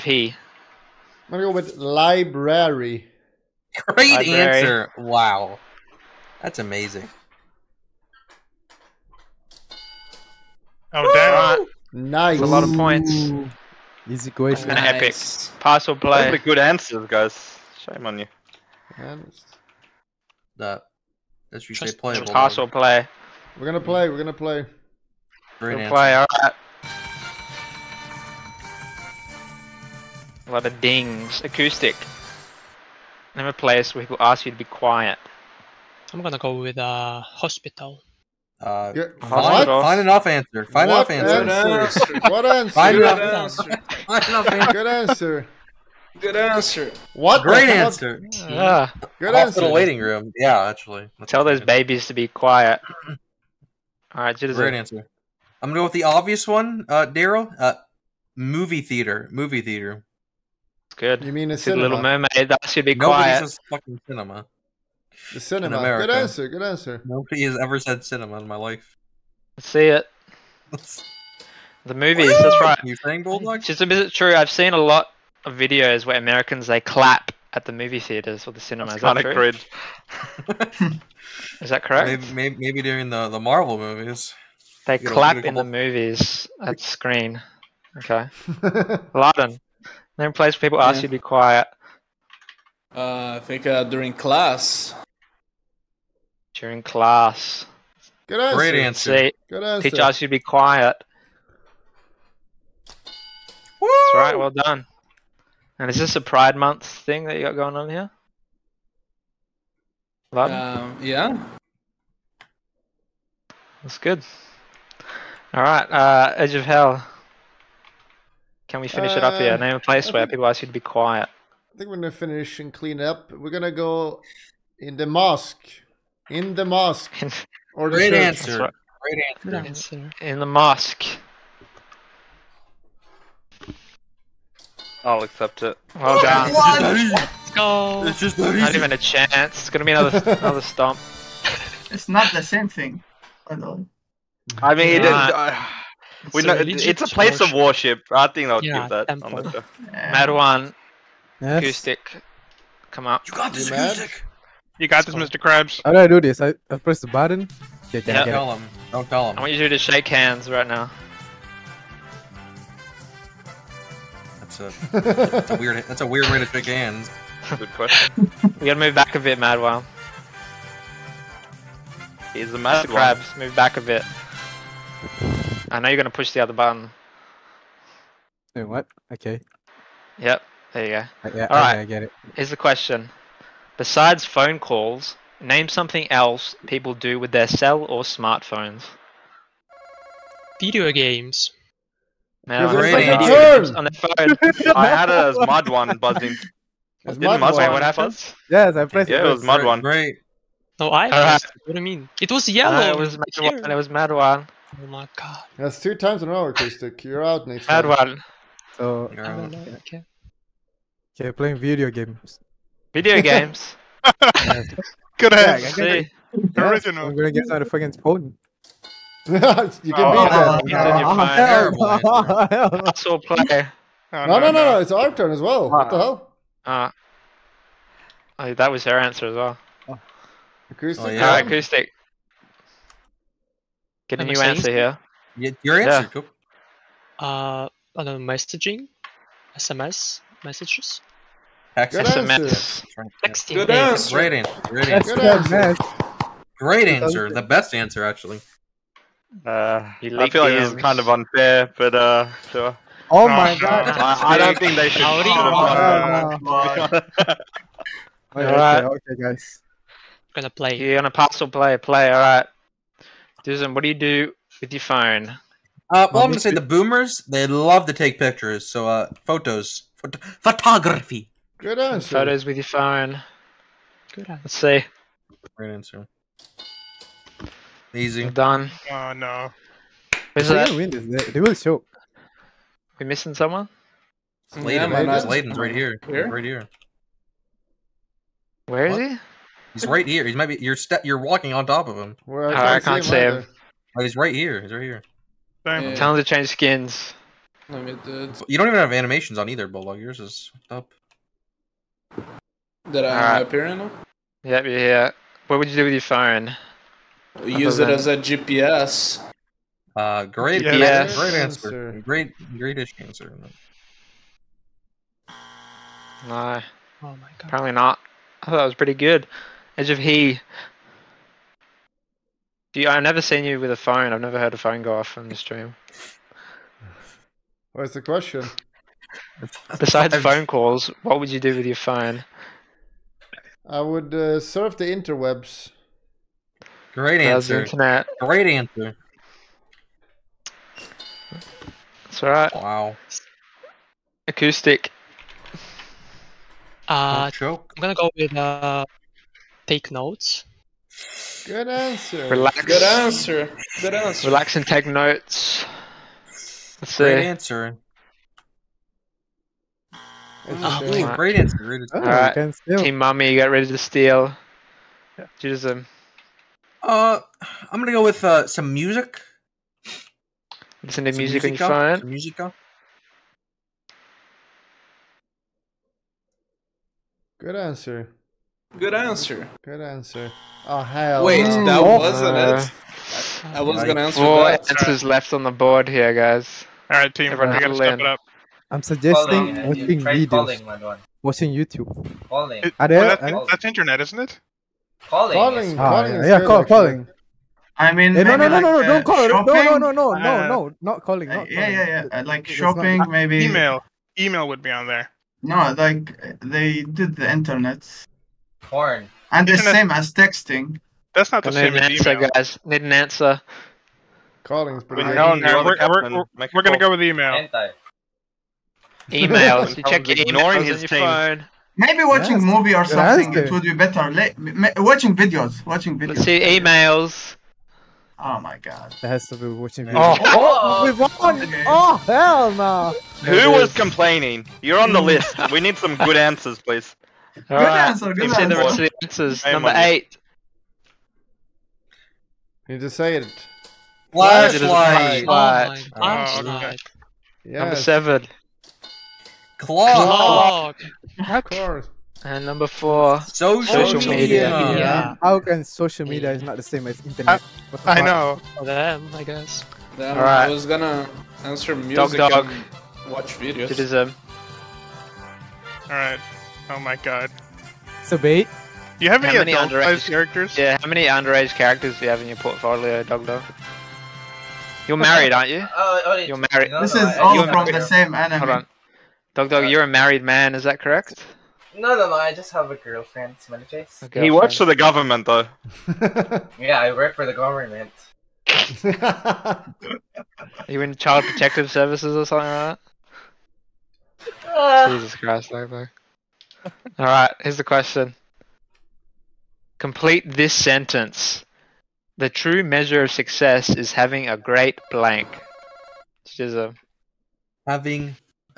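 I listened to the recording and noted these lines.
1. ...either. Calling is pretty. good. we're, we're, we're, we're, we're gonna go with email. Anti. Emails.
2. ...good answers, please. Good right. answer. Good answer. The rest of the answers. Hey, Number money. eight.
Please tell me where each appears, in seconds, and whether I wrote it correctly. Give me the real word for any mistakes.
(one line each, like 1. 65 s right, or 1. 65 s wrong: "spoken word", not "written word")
1. 412 s wrong: "answer", not "either"
2. 435 s right.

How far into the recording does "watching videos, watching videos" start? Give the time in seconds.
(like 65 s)
424 s.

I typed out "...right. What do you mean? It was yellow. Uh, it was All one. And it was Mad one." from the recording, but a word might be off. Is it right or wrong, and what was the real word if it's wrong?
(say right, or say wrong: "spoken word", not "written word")
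wrong: "Mad", not "All".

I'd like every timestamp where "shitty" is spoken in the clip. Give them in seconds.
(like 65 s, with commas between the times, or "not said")
not said.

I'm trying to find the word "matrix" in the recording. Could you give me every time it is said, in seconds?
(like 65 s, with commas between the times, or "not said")
not said.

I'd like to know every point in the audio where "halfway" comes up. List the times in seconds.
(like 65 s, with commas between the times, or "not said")
not said.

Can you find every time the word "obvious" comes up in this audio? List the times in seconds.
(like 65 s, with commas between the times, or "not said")
56 s.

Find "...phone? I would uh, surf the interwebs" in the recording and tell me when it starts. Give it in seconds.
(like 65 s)
331 s.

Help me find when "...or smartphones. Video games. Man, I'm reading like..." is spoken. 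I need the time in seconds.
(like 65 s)
187 s.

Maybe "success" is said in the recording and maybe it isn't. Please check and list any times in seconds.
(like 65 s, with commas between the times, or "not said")
503 s.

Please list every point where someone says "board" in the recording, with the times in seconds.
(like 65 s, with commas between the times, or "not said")
385 s.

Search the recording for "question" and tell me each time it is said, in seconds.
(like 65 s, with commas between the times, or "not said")
14 s, 167 s, 182 s, 328 s, 497 s.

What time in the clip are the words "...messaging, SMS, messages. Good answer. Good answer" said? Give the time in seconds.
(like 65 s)
238 s.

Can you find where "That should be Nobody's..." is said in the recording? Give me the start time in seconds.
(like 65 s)
62 s.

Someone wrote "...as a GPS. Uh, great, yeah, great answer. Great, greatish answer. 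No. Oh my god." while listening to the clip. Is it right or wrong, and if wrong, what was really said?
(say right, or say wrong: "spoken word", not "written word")
right.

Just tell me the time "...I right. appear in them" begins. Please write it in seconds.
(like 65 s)
303 s.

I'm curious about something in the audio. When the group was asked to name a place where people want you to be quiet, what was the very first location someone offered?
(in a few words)
hospital.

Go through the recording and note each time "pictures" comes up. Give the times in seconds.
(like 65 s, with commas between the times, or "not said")
268 s.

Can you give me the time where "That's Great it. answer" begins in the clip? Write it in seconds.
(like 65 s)
356 s.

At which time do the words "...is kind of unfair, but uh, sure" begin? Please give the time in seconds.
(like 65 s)
250 s.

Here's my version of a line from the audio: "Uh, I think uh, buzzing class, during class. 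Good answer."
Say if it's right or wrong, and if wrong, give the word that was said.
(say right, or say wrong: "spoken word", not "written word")
wrong: "during", not "buzzing".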